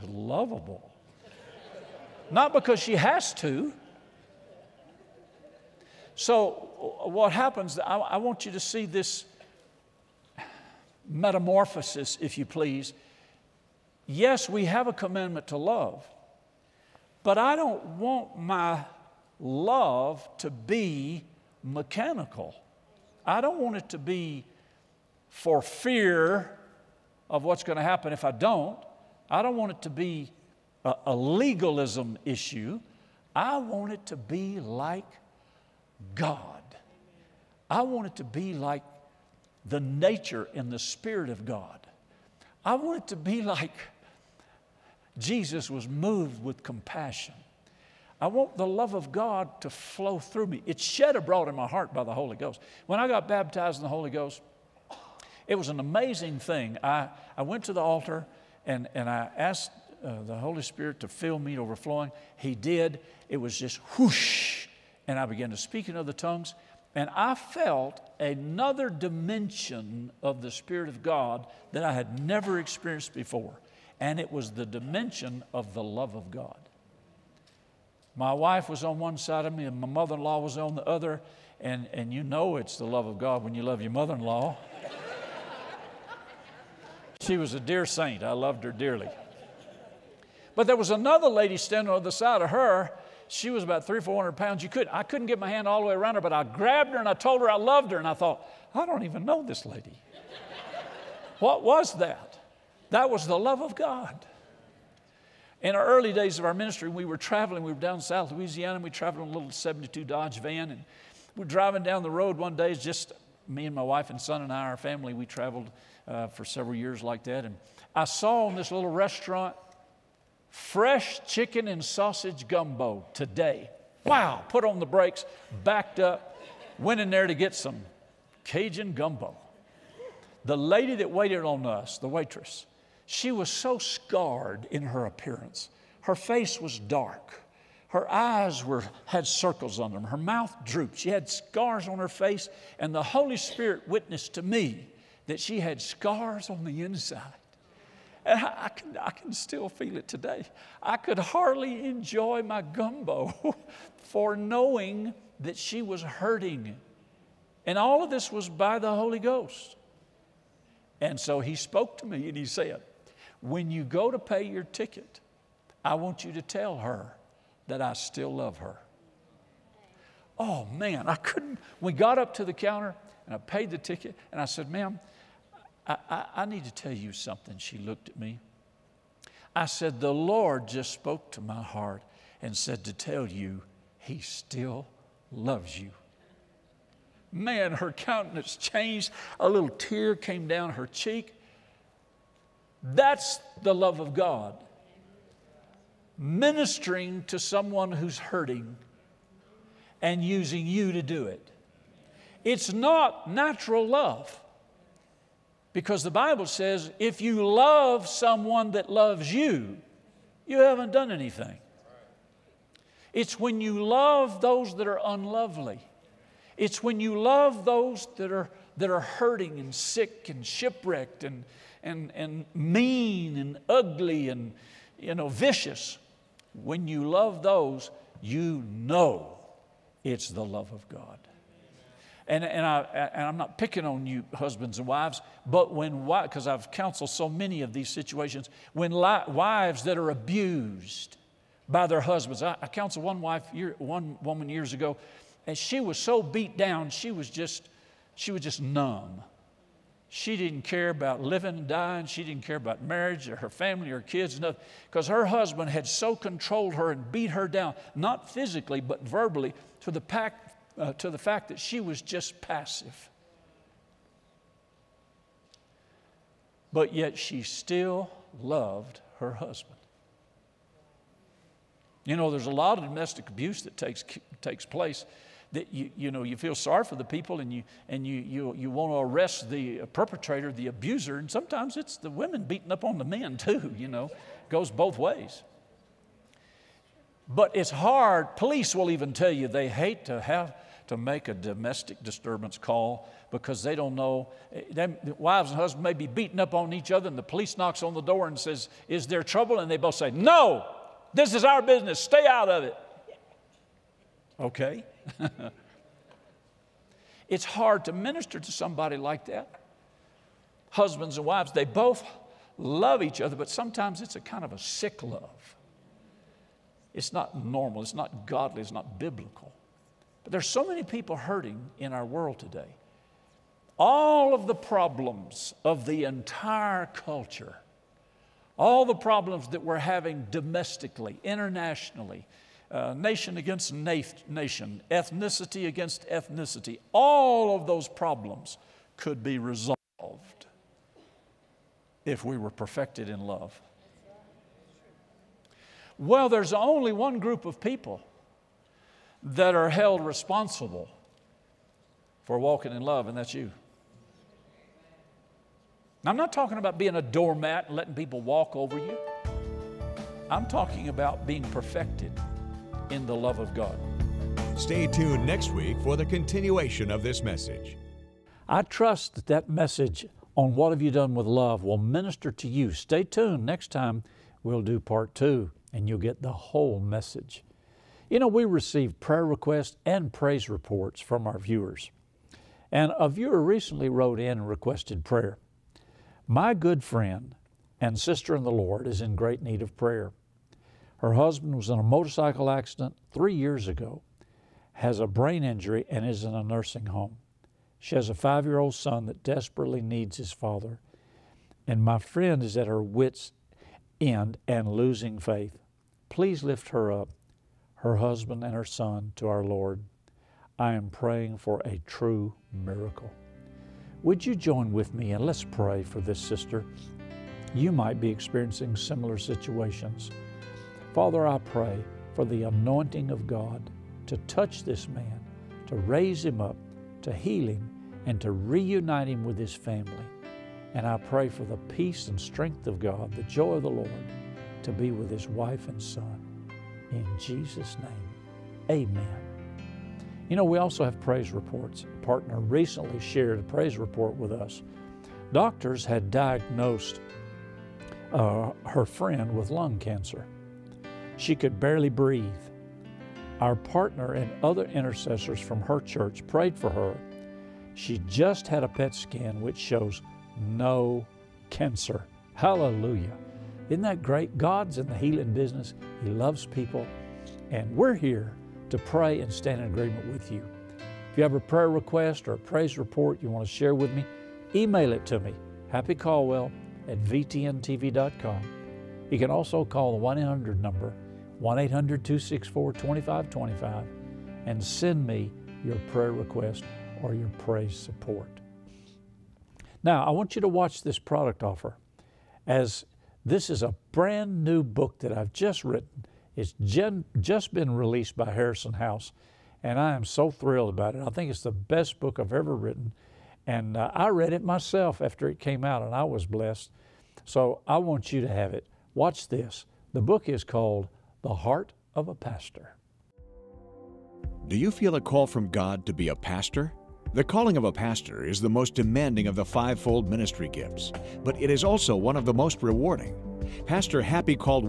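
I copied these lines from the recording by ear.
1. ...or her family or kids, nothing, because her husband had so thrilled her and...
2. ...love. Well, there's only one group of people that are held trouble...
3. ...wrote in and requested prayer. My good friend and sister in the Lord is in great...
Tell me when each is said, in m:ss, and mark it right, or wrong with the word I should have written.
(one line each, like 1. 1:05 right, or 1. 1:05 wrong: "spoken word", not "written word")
1. 4:13 wrong: "controlled", not "thrilled"
2. 5:43 wrong: "responsible", not "trouble"
3. 6:23 right.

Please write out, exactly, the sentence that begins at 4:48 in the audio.
Police will even tell you they hate to have to make a domestic disturbance call because they don't know.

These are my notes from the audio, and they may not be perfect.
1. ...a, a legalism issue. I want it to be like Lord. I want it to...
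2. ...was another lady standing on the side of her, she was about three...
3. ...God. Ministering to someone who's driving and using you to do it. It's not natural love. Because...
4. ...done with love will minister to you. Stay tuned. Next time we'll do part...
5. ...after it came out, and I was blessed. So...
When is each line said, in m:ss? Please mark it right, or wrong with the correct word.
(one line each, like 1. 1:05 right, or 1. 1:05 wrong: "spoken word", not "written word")
1. 0:30 wrong: "God", not "Lord"
2. 1:30 right
3. 3:14 wrong: "hurting", not "driving"
4. 6:10 right
5. 8:25 right.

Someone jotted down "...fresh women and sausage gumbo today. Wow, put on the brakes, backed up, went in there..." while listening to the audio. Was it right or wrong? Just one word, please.
wrong.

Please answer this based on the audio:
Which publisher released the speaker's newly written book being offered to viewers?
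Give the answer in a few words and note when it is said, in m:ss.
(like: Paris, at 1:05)
Harrison House, at 8:18.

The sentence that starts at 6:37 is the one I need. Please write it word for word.
She has a five year old son that desperately needs his father.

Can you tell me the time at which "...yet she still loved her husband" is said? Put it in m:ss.
4:26.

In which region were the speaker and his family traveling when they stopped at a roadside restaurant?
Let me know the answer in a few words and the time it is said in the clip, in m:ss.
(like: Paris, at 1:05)
South Louisiana, at 1:48.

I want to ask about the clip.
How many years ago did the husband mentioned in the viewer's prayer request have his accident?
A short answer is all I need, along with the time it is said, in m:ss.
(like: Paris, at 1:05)
3 years, at 6:33.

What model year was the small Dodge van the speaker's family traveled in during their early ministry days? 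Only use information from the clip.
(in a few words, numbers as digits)
1972.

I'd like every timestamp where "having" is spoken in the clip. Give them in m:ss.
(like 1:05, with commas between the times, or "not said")
5:29.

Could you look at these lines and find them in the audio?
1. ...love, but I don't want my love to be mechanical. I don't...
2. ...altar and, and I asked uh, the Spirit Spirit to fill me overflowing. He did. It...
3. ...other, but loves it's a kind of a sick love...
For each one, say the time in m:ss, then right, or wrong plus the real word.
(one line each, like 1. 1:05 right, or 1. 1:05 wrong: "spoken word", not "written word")
1. 0:15 right
2. 0:57 wrong: "Holy", not "Spirit"
3. 5:13 wrong: "sometimes", not "loves".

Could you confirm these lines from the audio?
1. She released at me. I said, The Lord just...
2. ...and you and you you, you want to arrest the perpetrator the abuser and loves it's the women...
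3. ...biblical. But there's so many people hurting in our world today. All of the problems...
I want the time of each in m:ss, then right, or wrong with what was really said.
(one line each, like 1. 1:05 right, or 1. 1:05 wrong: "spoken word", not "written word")
1. 2:57 wrong: "looked", not "released"
2. 4:37 wrong: "sometimes", not "loves"
3. 5:18 right.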